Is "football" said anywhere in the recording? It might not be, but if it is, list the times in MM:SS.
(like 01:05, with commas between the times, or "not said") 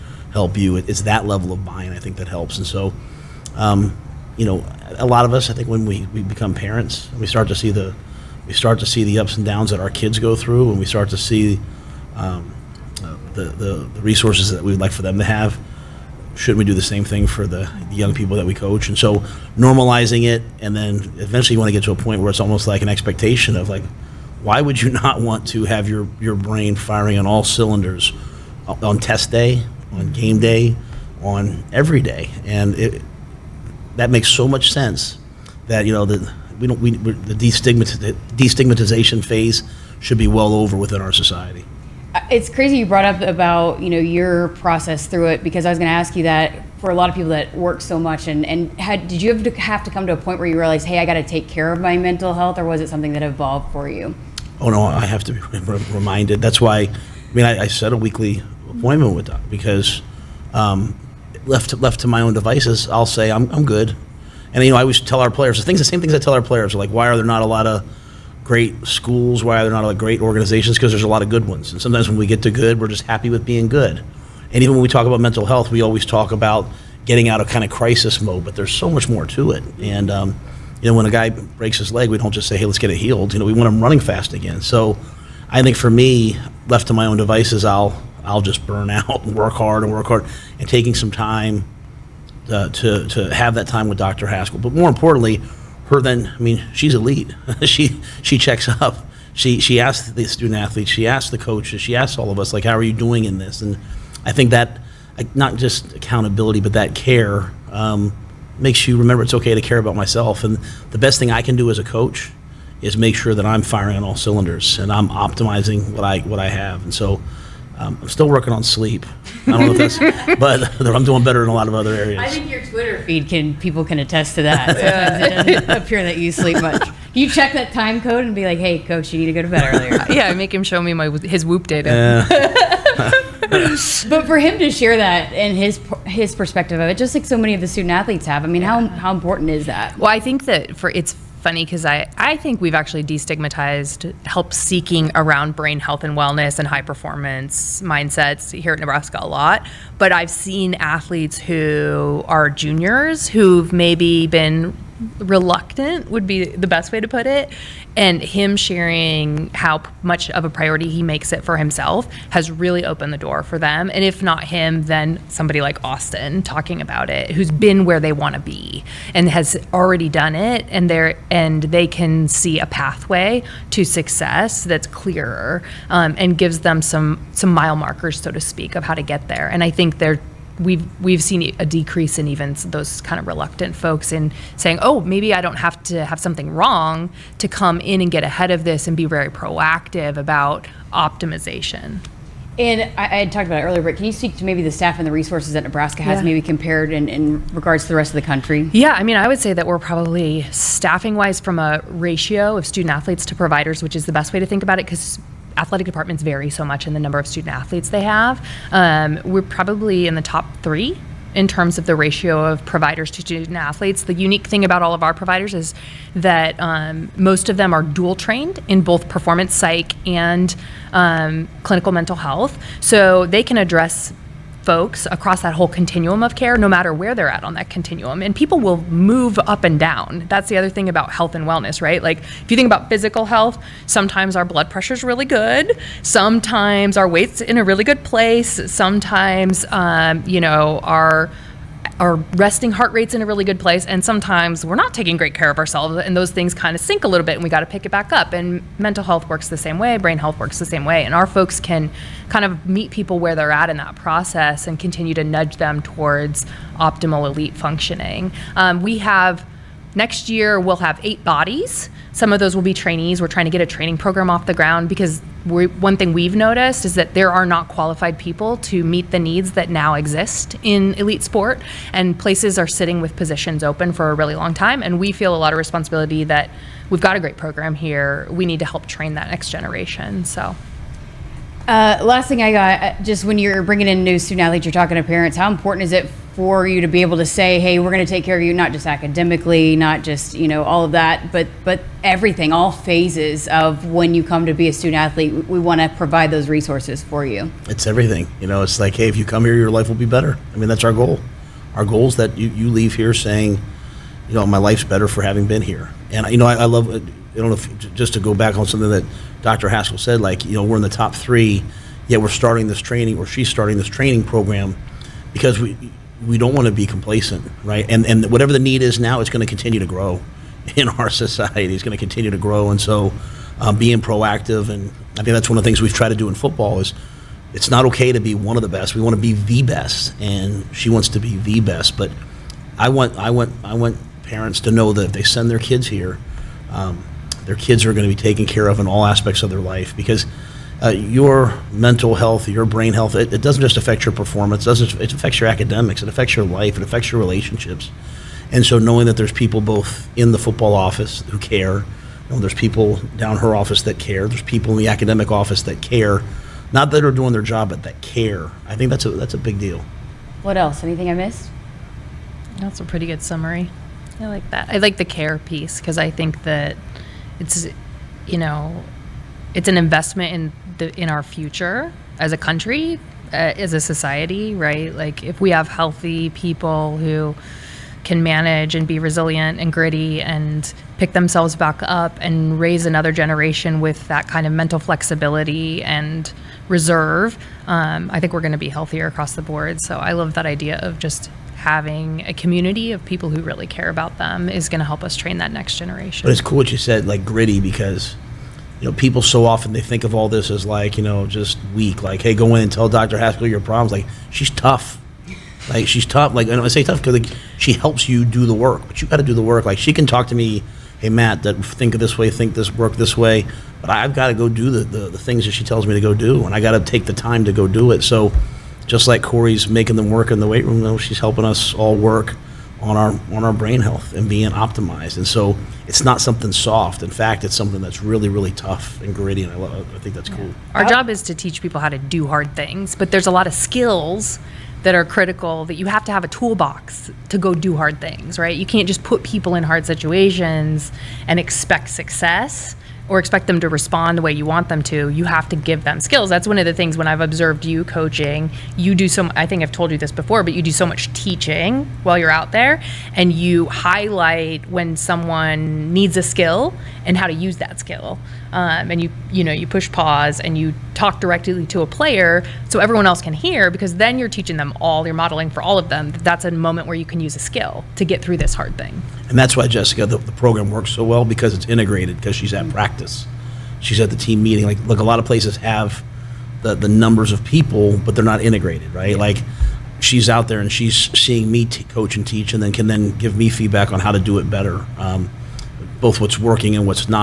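05:26, 05:50.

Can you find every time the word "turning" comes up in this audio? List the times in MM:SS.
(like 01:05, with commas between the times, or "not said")
not said.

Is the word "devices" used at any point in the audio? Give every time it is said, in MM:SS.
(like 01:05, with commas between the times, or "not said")
01:02, 01:27.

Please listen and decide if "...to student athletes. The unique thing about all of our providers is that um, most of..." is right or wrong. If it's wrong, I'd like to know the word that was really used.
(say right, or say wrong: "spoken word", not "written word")
right.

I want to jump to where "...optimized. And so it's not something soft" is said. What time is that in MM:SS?
07:04.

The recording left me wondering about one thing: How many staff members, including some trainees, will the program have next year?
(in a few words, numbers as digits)
8.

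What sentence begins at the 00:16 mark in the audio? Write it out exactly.
Shouldn't we do the same thing for the young people that we coach?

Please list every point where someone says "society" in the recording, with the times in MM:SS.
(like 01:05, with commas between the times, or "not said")
00:41, 05:21, 06:13.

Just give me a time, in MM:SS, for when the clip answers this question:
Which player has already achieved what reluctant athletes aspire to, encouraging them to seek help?
02:45.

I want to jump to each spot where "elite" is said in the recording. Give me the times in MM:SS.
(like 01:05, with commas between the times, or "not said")
01:36, 04:17, 04:30.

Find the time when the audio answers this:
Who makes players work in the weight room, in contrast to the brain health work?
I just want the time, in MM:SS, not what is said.
06:59.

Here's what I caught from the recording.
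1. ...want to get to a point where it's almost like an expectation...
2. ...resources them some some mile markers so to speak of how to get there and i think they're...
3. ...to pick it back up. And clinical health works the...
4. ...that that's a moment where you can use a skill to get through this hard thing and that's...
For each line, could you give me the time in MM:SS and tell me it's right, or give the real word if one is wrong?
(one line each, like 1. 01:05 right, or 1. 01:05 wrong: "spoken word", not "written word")
1. 00:21 right
2. 02:56 wrong: "gives", not "resources"
3. 04:07 wrong: "mental", not "clinical"
4. 07:46 right.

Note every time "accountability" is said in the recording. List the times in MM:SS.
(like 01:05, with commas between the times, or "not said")
01:45.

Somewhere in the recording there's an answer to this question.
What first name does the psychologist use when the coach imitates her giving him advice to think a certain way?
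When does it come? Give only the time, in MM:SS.
06:51.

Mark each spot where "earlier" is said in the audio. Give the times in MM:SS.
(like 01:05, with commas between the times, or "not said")
02:09, 03:13.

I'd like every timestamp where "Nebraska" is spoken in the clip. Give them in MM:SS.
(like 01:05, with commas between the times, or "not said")
02:28, 03:15.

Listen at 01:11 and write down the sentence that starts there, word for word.
And sometimes when we get to good, we're just happy with being good.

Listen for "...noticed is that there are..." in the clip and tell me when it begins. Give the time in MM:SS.
04:26.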